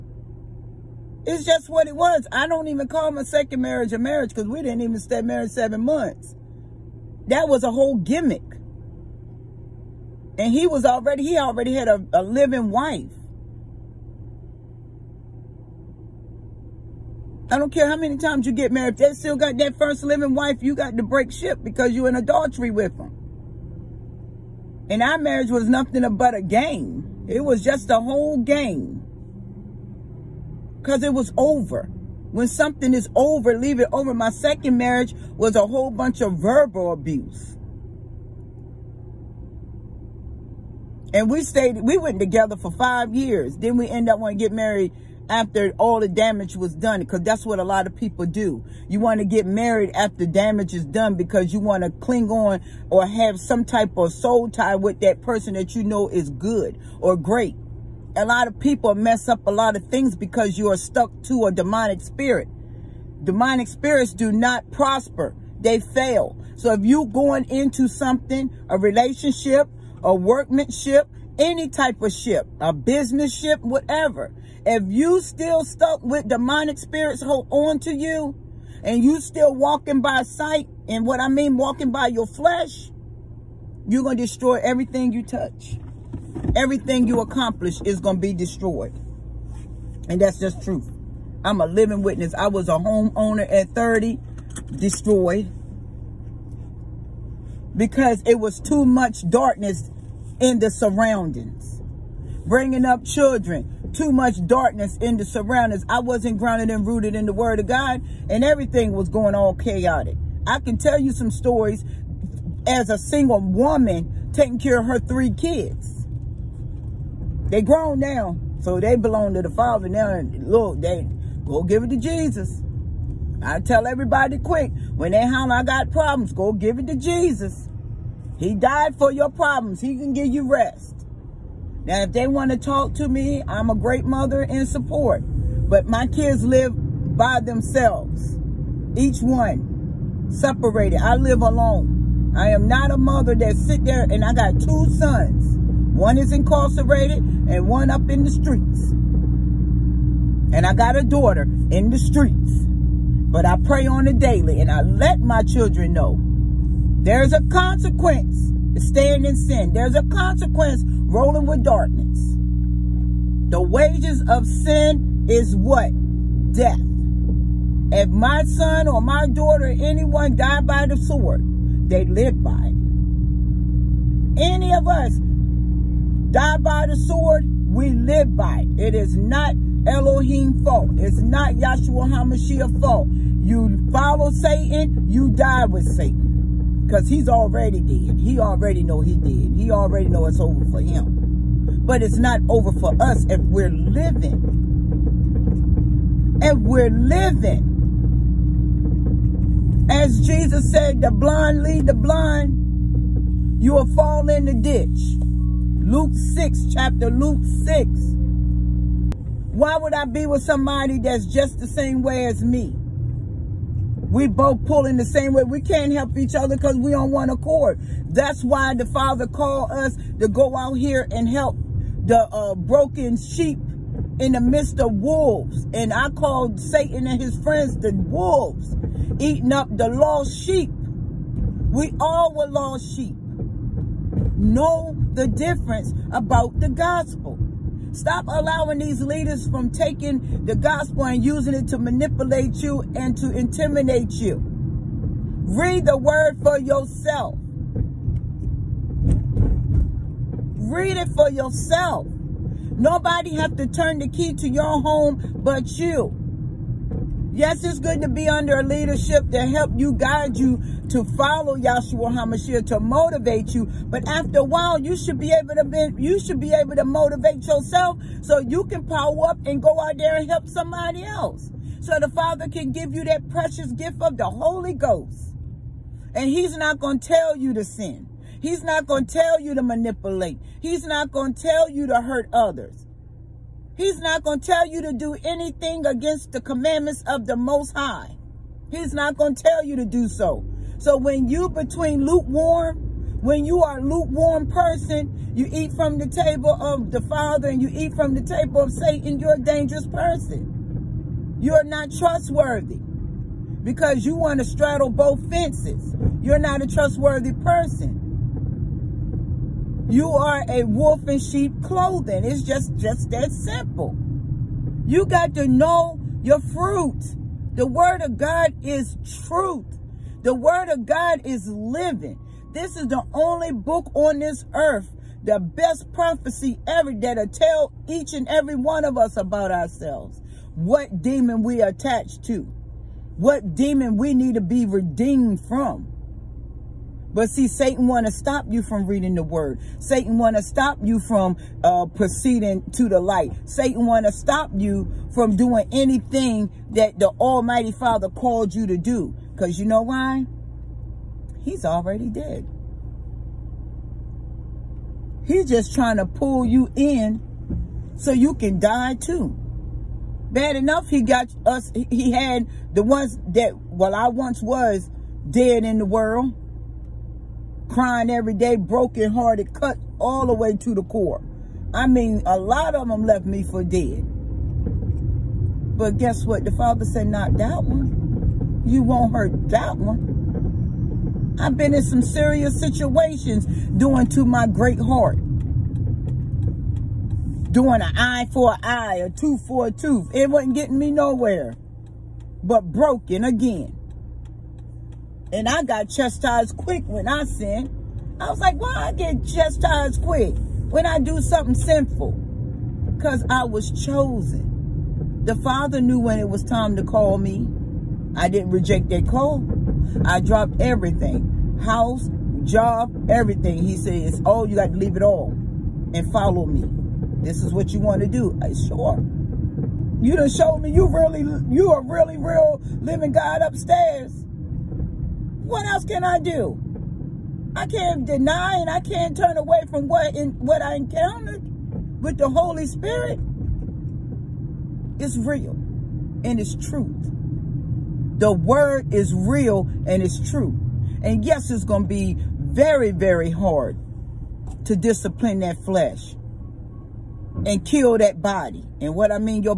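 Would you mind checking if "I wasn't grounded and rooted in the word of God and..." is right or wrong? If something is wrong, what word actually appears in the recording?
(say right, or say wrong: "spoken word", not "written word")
right.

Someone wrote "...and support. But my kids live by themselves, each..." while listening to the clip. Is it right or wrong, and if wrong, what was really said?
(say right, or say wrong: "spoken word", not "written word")
right.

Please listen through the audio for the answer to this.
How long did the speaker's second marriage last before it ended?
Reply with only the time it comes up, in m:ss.
0:05.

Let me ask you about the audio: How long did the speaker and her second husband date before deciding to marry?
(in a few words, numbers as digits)
5 years.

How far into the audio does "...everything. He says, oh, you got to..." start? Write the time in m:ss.
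6:53.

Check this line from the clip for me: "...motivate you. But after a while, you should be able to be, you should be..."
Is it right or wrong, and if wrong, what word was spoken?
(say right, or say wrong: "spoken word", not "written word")
right.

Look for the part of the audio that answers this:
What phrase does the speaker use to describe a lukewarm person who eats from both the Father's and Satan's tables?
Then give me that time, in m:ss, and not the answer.
5:10.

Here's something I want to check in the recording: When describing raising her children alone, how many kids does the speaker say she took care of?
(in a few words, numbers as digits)
3.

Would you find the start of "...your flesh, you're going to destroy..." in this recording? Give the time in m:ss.
1:22.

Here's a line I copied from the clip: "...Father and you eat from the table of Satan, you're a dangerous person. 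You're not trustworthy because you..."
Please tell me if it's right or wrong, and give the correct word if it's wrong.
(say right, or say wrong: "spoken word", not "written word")
right.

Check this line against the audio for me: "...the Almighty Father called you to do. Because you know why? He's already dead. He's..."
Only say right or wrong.
right.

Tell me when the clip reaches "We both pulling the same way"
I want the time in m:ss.
3:34.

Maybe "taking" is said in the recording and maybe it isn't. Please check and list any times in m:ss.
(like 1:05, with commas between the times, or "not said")
1:54, 3:59.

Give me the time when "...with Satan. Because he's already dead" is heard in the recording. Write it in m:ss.
3:05.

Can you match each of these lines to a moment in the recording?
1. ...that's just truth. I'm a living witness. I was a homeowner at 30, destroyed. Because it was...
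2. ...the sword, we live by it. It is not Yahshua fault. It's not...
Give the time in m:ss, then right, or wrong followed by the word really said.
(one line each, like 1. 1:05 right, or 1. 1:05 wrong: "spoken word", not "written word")
1. 1:30 right
2. 2:56 wrong: "Elohim", not "Yahshua".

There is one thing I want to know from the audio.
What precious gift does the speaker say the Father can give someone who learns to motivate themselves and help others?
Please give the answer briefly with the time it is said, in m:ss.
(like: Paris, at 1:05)
The Holy Ghost, at 4:34.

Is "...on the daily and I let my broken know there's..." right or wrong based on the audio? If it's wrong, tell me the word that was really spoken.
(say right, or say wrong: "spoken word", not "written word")
wrong: "children", not "broken".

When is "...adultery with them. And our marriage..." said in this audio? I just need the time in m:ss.
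0:22.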